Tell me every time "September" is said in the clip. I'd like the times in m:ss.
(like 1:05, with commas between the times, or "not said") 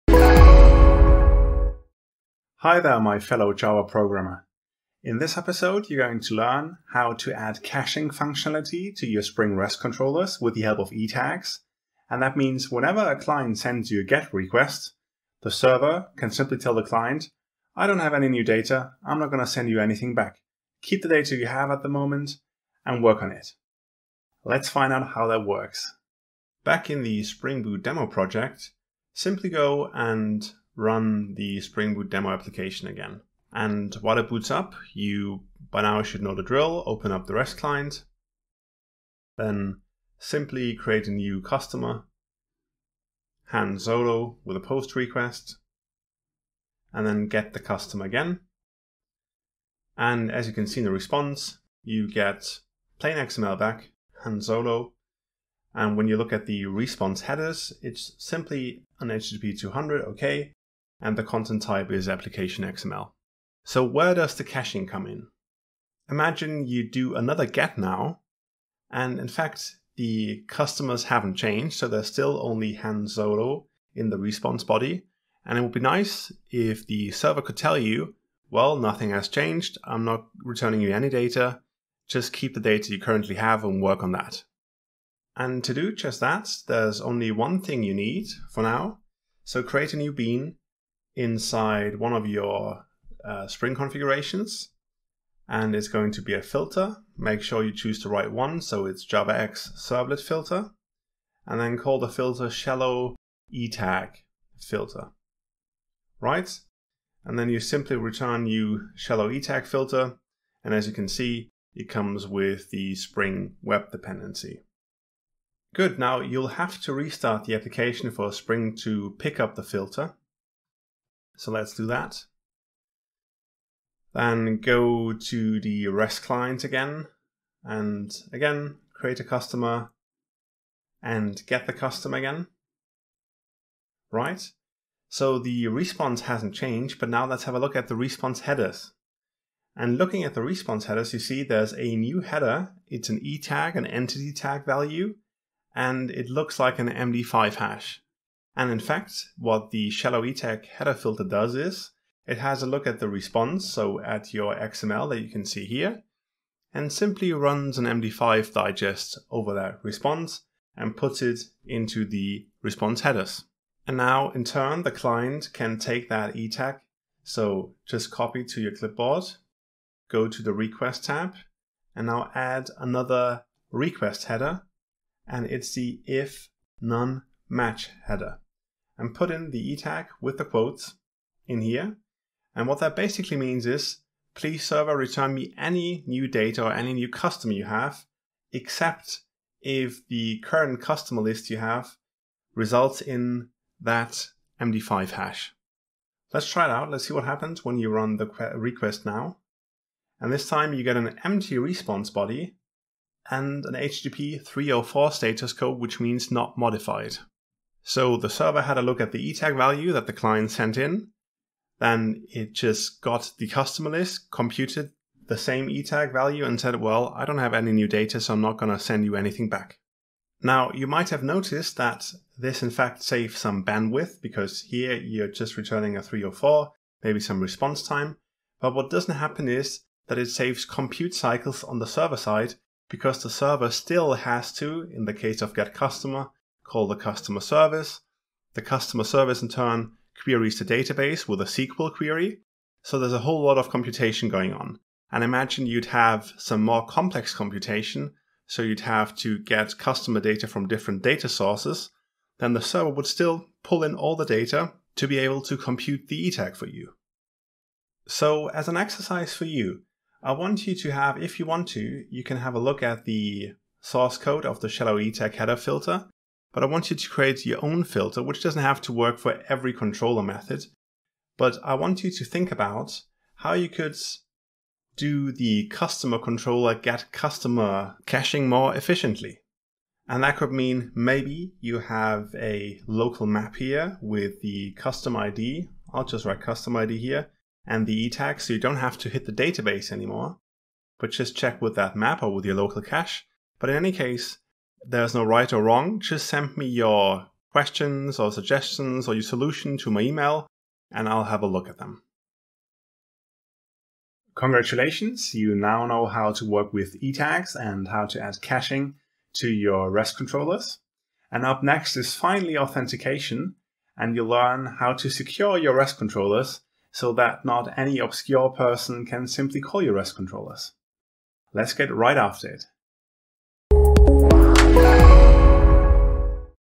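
not said.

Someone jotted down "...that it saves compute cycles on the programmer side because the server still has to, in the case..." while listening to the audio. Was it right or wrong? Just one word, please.
wrong.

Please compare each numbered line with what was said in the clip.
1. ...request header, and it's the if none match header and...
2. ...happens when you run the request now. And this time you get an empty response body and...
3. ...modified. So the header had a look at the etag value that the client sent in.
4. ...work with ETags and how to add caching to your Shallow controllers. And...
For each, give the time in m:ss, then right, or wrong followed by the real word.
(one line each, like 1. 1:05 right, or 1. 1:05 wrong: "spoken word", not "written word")
1. 2:53 right
2. 3:17 right
3. 3:26 wrong: "server", not "header"
4. 5:06 wrong: "REST", not "Shallow".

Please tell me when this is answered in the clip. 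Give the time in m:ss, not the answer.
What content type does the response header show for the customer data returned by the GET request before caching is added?
1:02.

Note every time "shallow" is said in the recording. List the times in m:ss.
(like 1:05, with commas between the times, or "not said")
1:42, 1:48, 2:29, 4:24.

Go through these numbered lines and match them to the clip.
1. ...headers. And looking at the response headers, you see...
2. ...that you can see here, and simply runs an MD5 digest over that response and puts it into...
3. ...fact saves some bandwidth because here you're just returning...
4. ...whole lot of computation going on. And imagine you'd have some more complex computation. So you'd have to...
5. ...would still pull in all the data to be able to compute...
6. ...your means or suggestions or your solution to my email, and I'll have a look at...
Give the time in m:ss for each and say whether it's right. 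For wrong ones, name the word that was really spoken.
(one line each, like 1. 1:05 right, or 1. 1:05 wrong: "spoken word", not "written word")
1. 2:18 right
2. 2:35 right
3. 3:42 right
4. 4:03 right
5. 4:12 right
6. 4:56 wrong: "questions", not "means".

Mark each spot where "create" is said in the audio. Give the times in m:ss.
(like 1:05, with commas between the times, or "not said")
0:40, 1:29, 2:08, 4:27.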